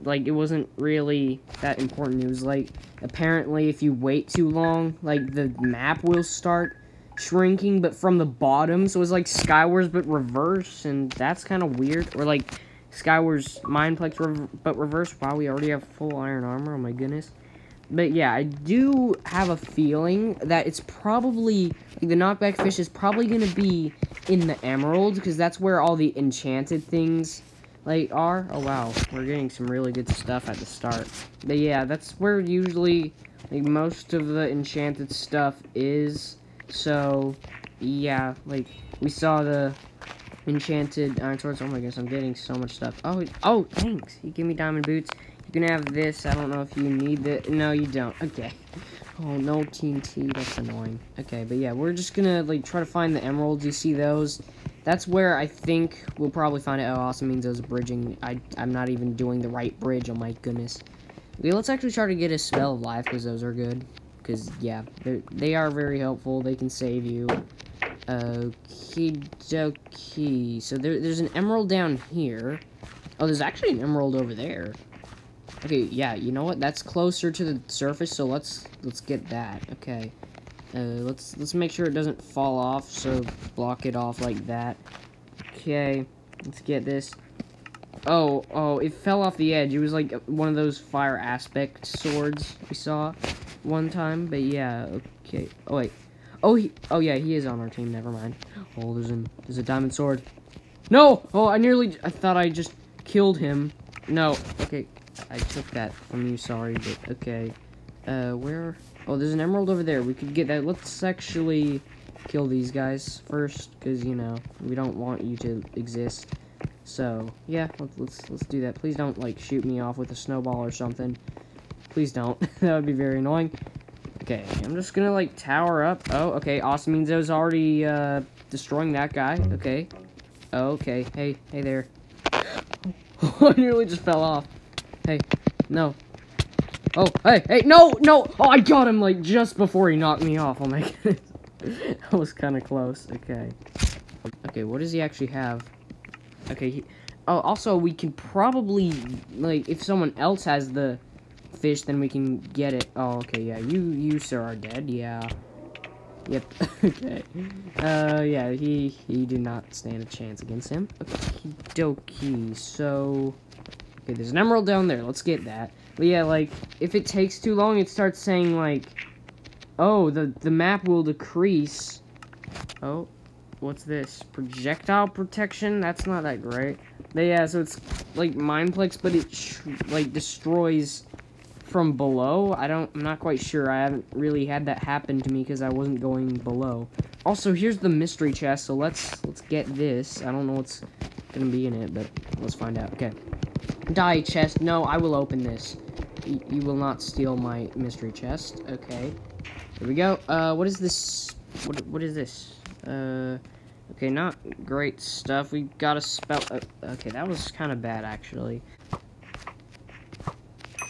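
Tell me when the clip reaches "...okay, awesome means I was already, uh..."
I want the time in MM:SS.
02:06.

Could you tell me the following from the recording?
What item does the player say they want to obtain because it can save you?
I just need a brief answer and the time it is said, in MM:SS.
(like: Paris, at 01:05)
spell of life, at 01:02.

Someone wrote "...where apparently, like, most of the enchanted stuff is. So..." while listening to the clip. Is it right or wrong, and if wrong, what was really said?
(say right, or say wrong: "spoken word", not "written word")
wrong: "usually", not "apparently".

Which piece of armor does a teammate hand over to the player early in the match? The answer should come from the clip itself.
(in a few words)
diamond boots.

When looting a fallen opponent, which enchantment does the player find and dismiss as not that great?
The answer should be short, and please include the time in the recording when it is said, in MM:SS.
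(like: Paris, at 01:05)
Projectile protection, at 02:54.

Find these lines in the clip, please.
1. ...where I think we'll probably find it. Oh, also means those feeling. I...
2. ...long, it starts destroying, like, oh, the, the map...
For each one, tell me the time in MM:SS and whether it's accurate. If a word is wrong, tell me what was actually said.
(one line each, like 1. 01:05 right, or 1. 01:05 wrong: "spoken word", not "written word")
1. 00:55 wrong: "bridging", not "feeling"
2. 02:47 wrong: "saying", not "destroying".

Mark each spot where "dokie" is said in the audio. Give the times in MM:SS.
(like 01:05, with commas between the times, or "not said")
01:09, 02:41.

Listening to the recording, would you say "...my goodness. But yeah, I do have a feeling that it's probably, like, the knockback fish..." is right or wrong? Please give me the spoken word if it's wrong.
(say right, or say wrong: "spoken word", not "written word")
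right.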